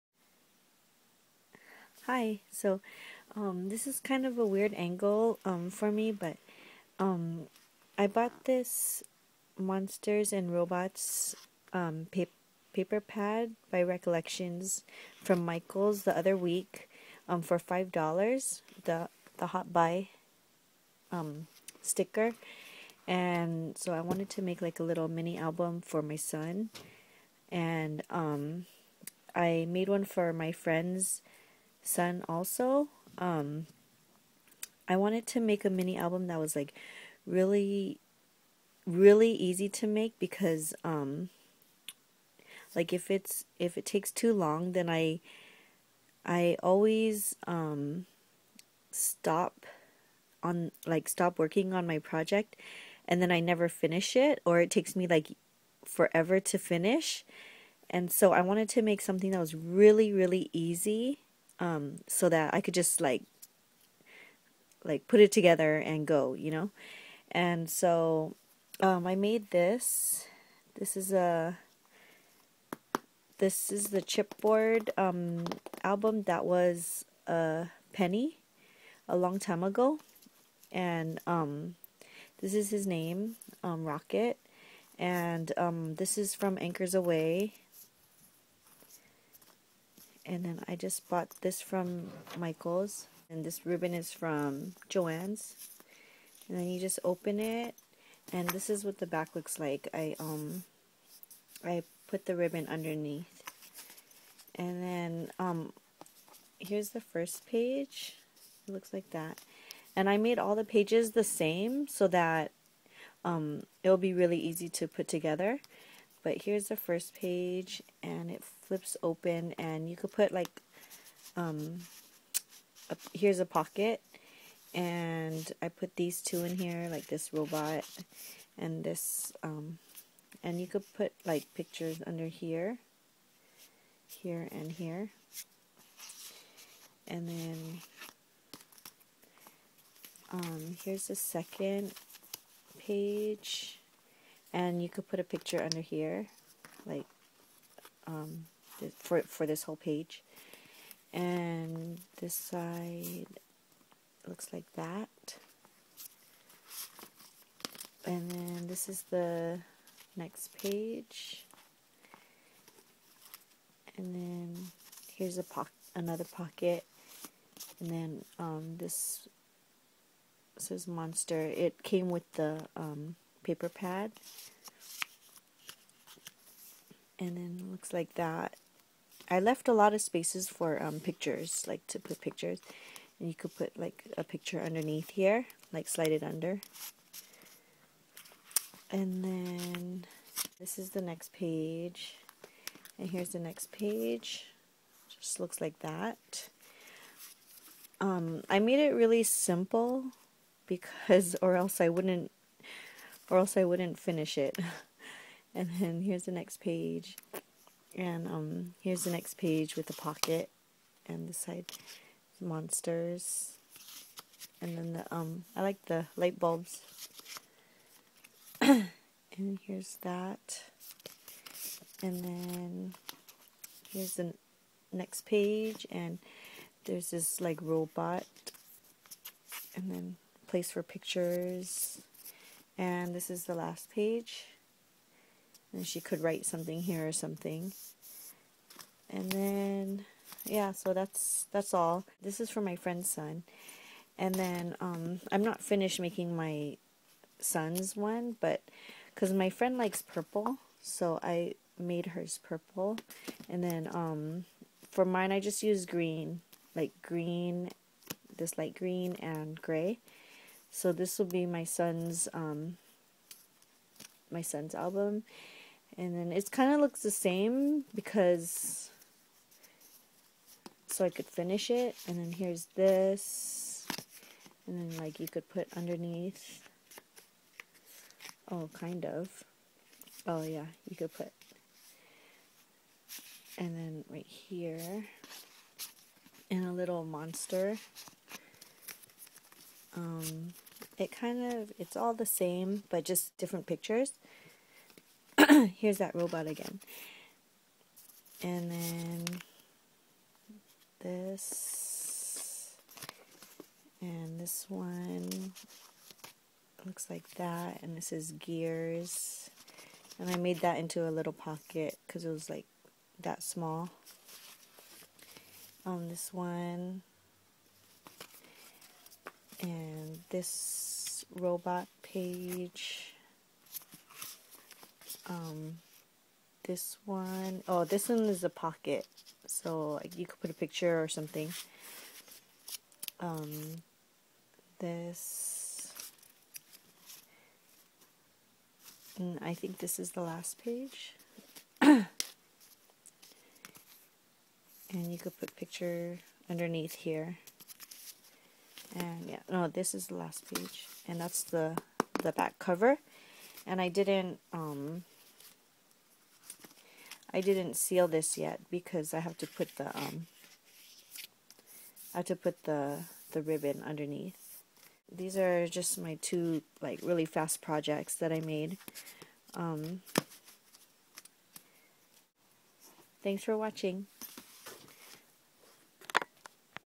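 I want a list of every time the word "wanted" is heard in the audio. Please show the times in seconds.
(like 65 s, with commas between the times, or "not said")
24 s, 34 s, 58 s.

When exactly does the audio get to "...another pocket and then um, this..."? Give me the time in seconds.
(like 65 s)
165 s.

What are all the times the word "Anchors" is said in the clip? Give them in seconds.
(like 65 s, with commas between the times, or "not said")
86 s.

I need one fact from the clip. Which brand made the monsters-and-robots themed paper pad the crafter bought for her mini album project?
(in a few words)
Recollections.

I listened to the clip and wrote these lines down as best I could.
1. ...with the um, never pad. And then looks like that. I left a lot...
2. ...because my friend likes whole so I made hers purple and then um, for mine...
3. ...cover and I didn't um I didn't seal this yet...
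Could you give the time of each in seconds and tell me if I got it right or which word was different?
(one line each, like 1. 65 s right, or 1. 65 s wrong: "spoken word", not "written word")
1. 172 s wrong: "paper", not "never"
2. 249 s wrong: "purple", not "whole"
3. 352 s right.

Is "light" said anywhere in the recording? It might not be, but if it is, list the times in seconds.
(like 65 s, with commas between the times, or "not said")
216 s, 258 s.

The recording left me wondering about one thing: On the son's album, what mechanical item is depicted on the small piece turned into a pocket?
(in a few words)
Gears.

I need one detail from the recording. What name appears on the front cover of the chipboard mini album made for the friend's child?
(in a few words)
Rocket.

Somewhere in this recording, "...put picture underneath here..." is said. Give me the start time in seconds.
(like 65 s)
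345 s.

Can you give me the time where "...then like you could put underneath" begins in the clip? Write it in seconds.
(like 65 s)
274 s.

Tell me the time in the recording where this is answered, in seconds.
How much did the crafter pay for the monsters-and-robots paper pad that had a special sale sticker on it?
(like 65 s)
17 s.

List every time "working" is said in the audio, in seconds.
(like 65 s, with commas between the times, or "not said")
51 s.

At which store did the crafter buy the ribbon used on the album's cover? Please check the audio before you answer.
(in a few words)
Joann's.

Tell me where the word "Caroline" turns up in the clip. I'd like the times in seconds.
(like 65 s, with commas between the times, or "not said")
not said.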